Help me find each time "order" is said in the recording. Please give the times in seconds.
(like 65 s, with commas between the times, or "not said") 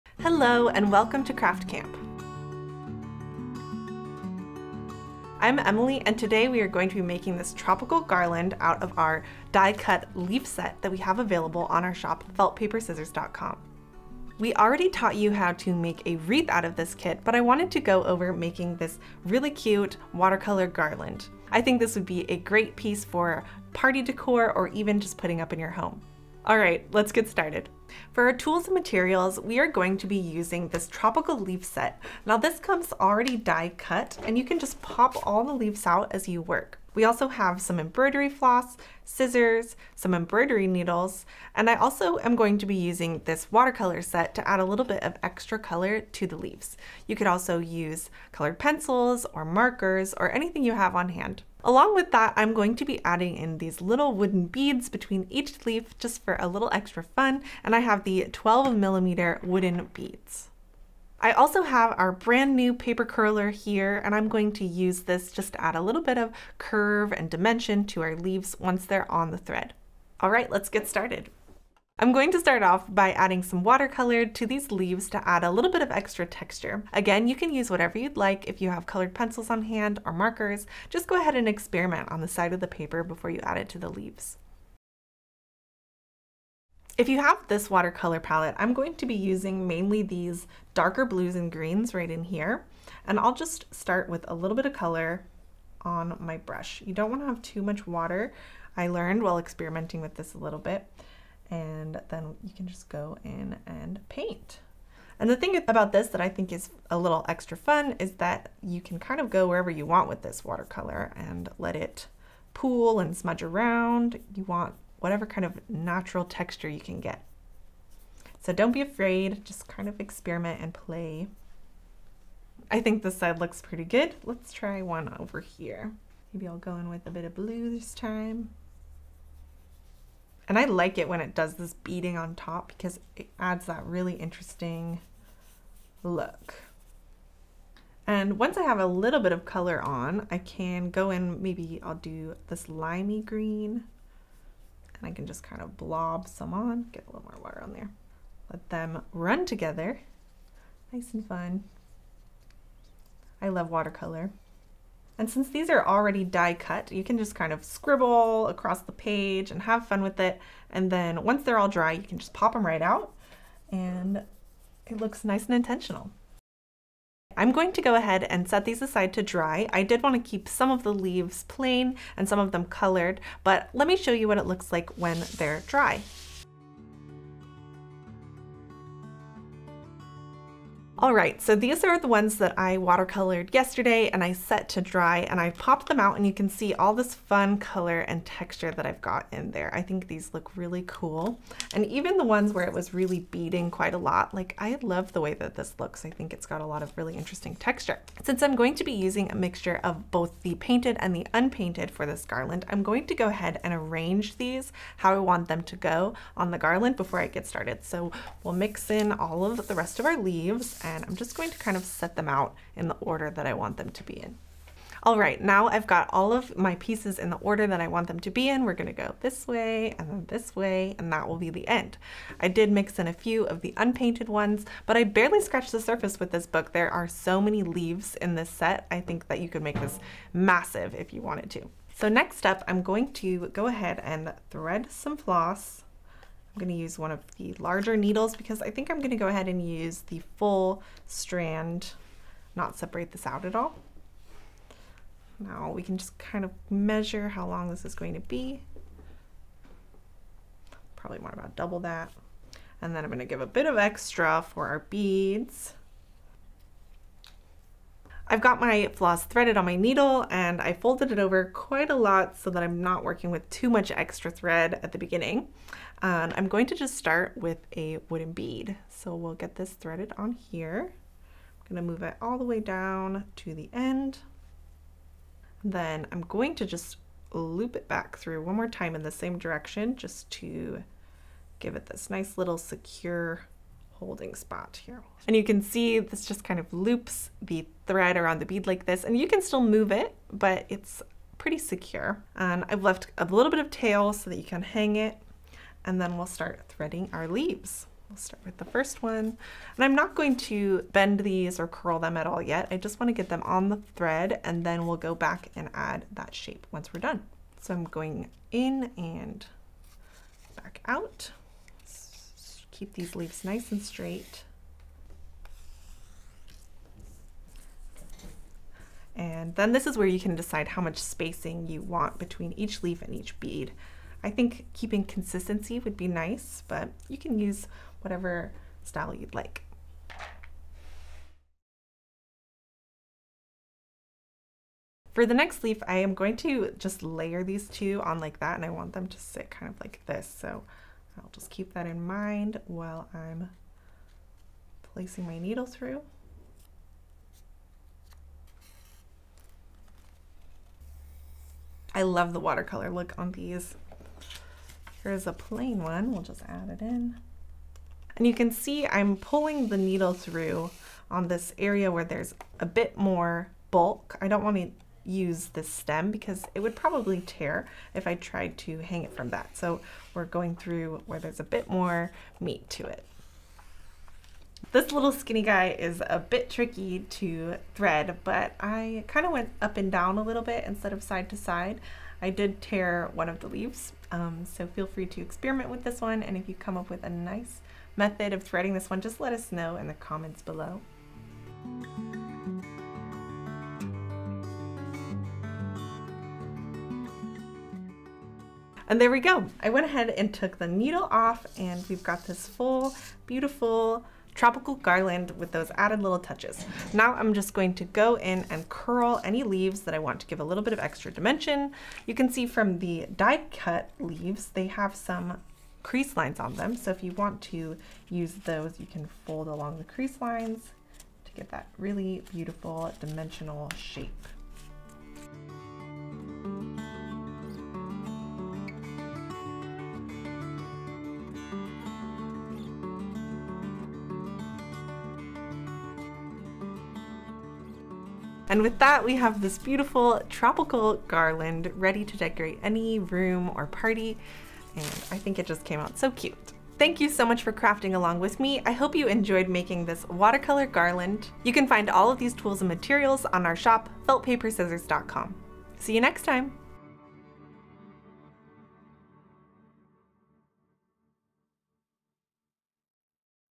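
212 s, 217 s.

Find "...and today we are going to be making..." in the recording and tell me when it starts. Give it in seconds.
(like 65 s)
6 s.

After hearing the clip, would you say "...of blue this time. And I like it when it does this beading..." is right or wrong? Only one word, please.
right.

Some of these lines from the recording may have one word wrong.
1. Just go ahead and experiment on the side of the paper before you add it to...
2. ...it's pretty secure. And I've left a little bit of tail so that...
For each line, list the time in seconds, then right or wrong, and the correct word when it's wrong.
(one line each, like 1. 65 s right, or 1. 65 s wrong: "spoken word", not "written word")
1. 80 s right
2. 290 s right.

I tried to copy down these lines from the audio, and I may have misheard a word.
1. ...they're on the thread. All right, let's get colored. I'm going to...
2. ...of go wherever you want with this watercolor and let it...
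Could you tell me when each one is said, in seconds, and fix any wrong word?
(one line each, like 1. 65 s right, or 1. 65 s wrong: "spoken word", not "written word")
1. 68 s wrong: "started", not "colored"
2. 109 s right.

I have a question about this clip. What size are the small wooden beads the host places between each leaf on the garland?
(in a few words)
12 millimeter.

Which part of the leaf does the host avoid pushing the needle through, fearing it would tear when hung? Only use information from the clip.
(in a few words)
stem.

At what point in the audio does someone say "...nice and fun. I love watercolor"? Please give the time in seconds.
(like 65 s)
150 s.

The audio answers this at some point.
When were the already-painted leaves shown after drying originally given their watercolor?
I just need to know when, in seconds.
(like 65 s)
183 s.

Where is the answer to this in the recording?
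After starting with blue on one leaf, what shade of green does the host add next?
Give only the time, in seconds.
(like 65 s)
142 s.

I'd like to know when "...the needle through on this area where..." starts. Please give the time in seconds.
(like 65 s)
359 s.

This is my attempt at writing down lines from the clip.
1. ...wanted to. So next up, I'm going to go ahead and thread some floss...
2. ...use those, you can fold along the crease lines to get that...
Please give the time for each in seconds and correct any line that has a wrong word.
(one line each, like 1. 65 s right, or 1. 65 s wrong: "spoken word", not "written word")
1. 231 s right
2. 418 s right.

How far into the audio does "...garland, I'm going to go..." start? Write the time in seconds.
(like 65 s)
202 s.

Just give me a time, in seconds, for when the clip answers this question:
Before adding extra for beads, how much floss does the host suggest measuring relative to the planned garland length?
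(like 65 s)
251 s.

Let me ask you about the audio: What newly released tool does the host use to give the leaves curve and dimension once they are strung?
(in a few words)
paper curler.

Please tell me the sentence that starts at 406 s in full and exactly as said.
Now I'm just going to go in and curl any leaves that I want to give a little bit of extra dimension.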